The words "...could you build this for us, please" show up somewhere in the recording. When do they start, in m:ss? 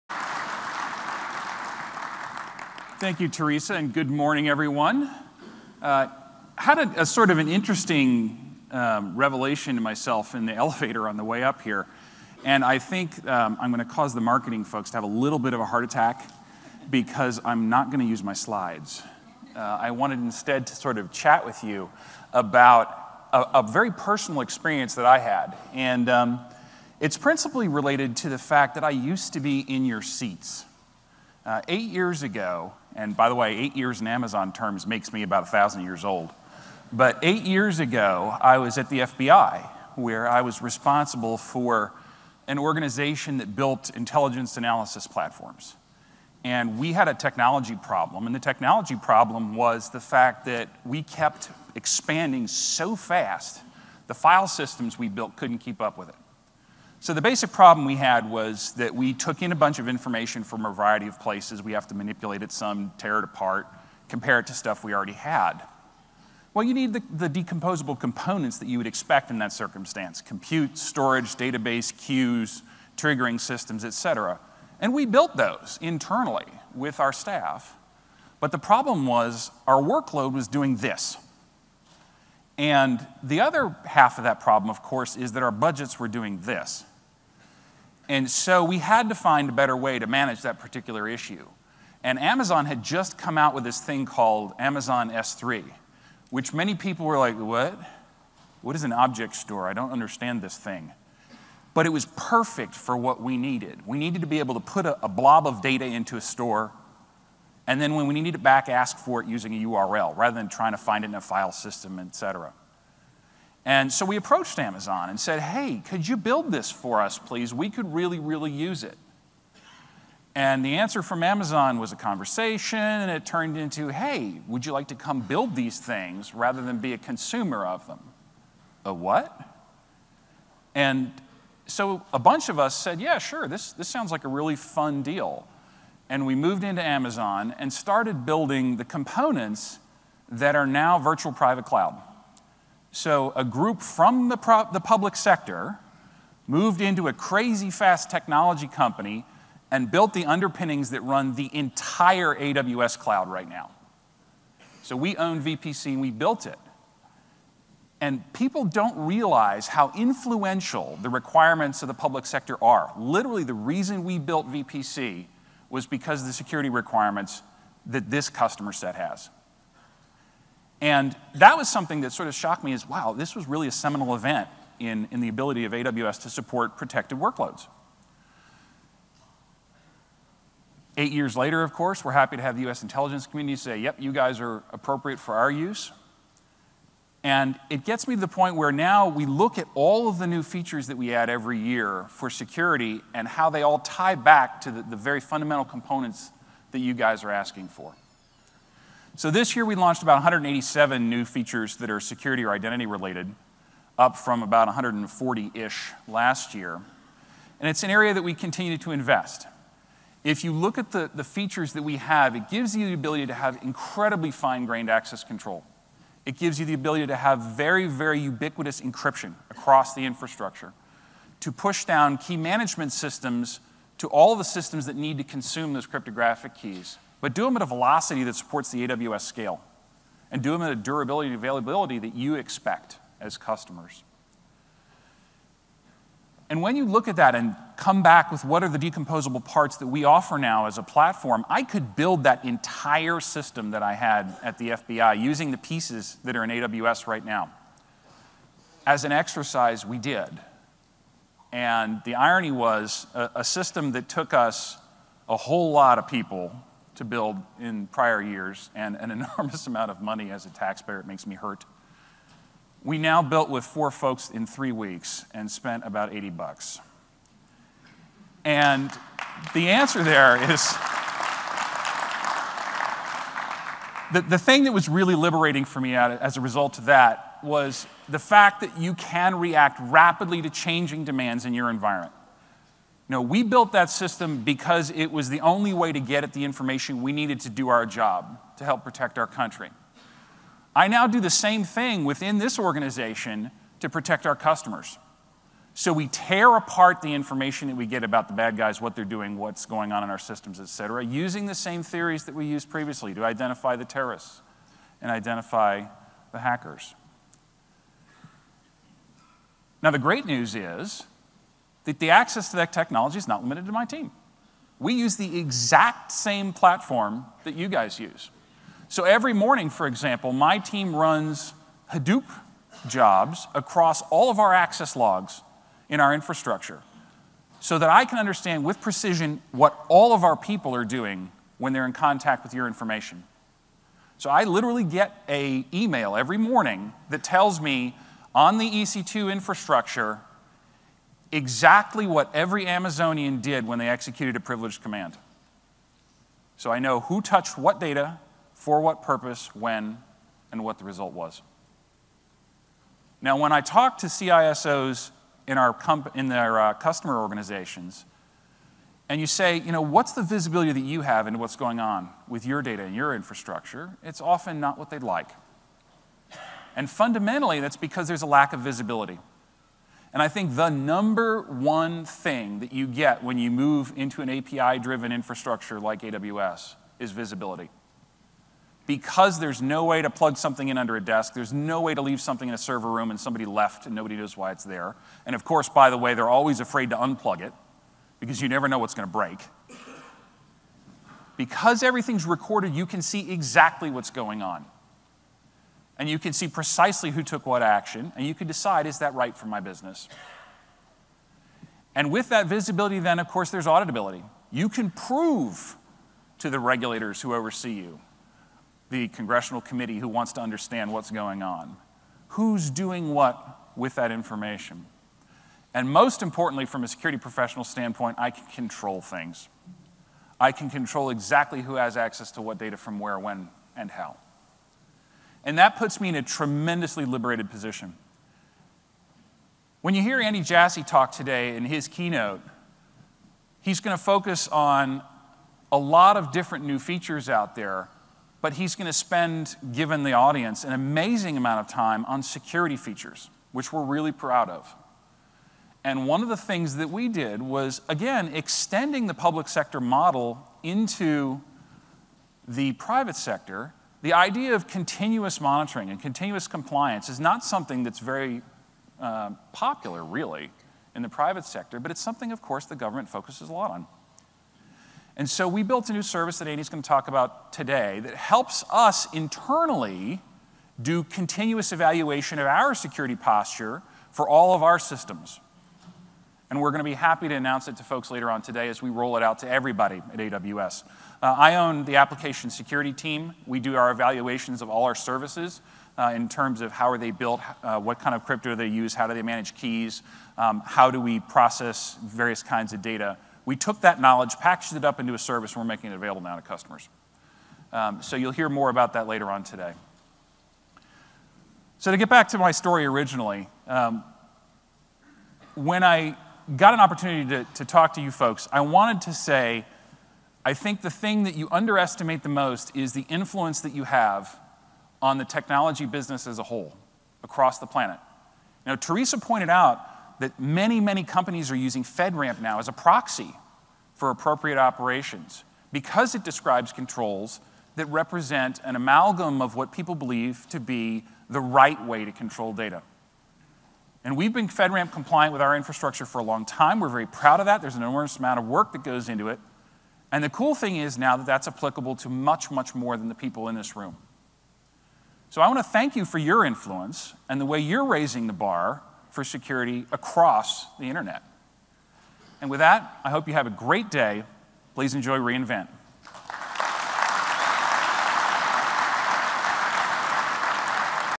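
1:55.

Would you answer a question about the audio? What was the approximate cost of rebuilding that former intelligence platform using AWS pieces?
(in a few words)
80 bucks.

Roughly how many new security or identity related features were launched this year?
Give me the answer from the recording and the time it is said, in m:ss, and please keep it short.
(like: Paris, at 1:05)
187, at 3:20.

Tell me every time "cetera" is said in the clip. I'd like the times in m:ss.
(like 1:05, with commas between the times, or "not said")
1:13, 1:52, 5:00.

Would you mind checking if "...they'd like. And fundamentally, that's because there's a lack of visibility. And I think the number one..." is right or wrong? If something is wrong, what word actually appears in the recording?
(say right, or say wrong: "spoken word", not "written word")
right.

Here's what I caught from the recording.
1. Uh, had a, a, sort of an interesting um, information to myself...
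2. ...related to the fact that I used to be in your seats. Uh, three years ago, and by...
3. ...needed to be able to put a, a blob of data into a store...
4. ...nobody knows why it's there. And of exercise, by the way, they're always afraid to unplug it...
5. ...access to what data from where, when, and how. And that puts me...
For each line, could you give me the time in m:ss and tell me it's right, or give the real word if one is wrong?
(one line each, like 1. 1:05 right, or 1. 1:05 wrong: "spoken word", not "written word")
1. 0:05 wrong: "revelation", not "information"
2. 0:27 wrong: "eight", not "three"
3. 1:43 right
4. 6:23 wrong: "course", not "exercise"
5. 7:01 right.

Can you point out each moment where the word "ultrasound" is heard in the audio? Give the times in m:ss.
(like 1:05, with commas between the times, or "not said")
not said.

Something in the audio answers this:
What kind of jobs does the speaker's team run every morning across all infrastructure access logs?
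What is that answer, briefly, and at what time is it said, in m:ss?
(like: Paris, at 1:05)
Hadoop jobs, at 5:21.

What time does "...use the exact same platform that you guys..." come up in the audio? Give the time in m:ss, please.
5:14.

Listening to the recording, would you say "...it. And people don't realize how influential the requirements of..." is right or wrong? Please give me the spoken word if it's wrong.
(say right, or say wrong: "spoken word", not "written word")
right.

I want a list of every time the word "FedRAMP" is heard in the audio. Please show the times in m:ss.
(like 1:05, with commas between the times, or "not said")
8:41, 8:54.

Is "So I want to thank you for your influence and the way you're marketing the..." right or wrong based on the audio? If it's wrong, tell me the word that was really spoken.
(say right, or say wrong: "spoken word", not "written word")
wrong: "raising", not "marketing".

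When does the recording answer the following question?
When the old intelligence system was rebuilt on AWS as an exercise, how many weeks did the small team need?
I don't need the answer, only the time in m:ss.
4:24.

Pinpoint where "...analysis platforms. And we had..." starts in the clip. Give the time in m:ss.
0:44.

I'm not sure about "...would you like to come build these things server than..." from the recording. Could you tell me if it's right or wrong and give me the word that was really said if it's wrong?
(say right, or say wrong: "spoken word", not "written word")
wrong: "rather", not "server".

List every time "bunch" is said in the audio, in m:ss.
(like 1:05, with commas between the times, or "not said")
0:59, 2:12.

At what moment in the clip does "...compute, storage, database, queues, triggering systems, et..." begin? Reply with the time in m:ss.
1:10.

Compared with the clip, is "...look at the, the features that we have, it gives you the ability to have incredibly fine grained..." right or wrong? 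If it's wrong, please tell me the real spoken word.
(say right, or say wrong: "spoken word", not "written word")
right.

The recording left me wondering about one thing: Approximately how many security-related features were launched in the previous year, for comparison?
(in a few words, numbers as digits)
140.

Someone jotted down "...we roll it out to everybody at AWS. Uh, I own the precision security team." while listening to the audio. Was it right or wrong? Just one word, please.
wrong.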